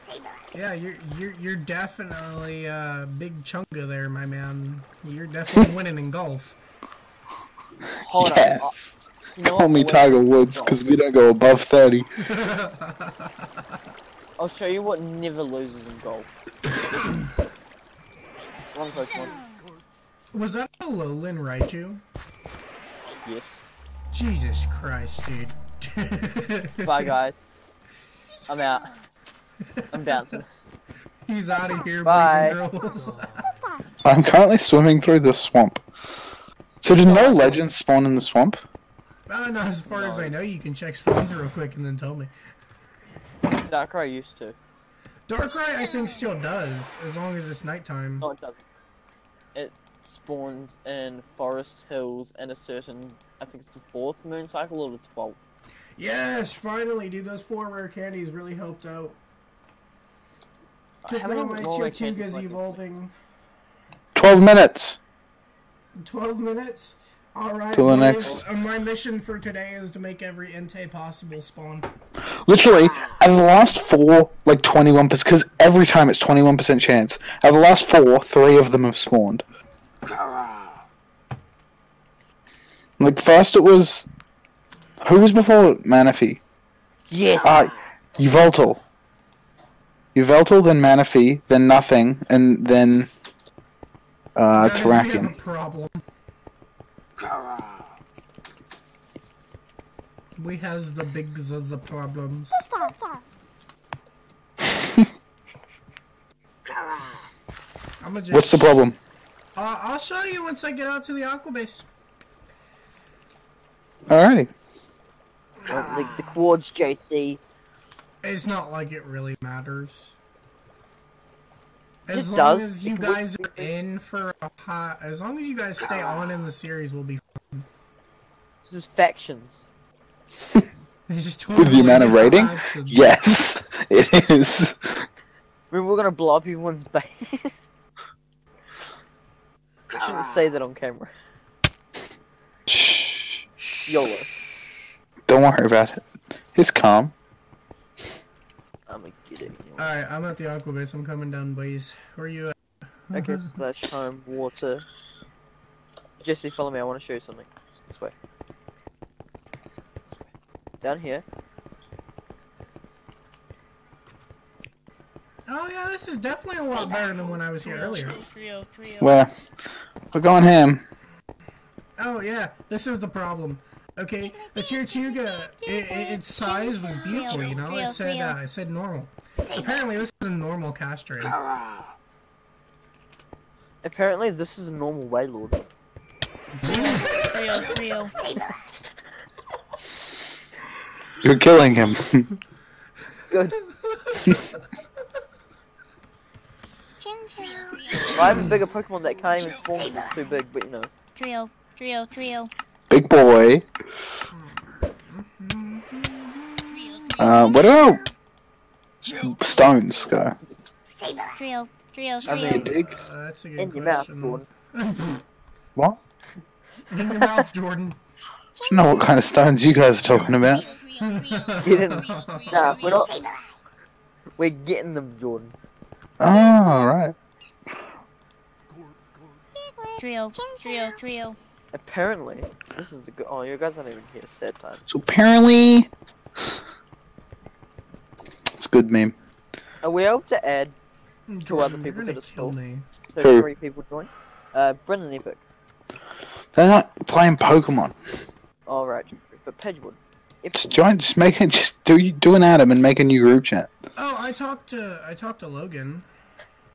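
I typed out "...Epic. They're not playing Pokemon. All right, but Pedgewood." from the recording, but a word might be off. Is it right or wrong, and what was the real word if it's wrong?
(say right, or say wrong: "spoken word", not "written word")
right.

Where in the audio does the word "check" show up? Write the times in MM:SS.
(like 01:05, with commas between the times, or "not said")
00:40.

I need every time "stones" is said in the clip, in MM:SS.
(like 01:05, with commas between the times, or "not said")
03:29, 03:39.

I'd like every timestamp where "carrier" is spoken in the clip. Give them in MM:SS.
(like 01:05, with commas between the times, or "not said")
not said.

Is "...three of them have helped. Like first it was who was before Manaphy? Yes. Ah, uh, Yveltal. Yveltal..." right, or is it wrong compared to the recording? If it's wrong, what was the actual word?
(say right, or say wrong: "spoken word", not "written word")
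wrong: "spawned", not "helped".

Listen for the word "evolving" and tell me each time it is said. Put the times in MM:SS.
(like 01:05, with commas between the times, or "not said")
01:02.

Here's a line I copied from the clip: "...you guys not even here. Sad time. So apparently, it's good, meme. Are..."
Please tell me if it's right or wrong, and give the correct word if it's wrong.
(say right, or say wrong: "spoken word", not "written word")
right.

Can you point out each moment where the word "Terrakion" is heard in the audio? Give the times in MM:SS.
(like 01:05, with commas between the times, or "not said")
01:34.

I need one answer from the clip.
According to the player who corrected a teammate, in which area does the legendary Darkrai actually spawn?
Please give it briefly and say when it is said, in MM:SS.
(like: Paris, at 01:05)
Forest Hills, at 00:51.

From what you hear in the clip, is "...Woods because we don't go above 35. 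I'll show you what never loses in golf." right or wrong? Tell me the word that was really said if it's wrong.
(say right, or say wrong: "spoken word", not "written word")
wrong: "30", not "35".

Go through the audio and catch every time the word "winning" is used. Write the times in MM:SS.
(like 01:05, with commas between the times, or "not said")
00:05.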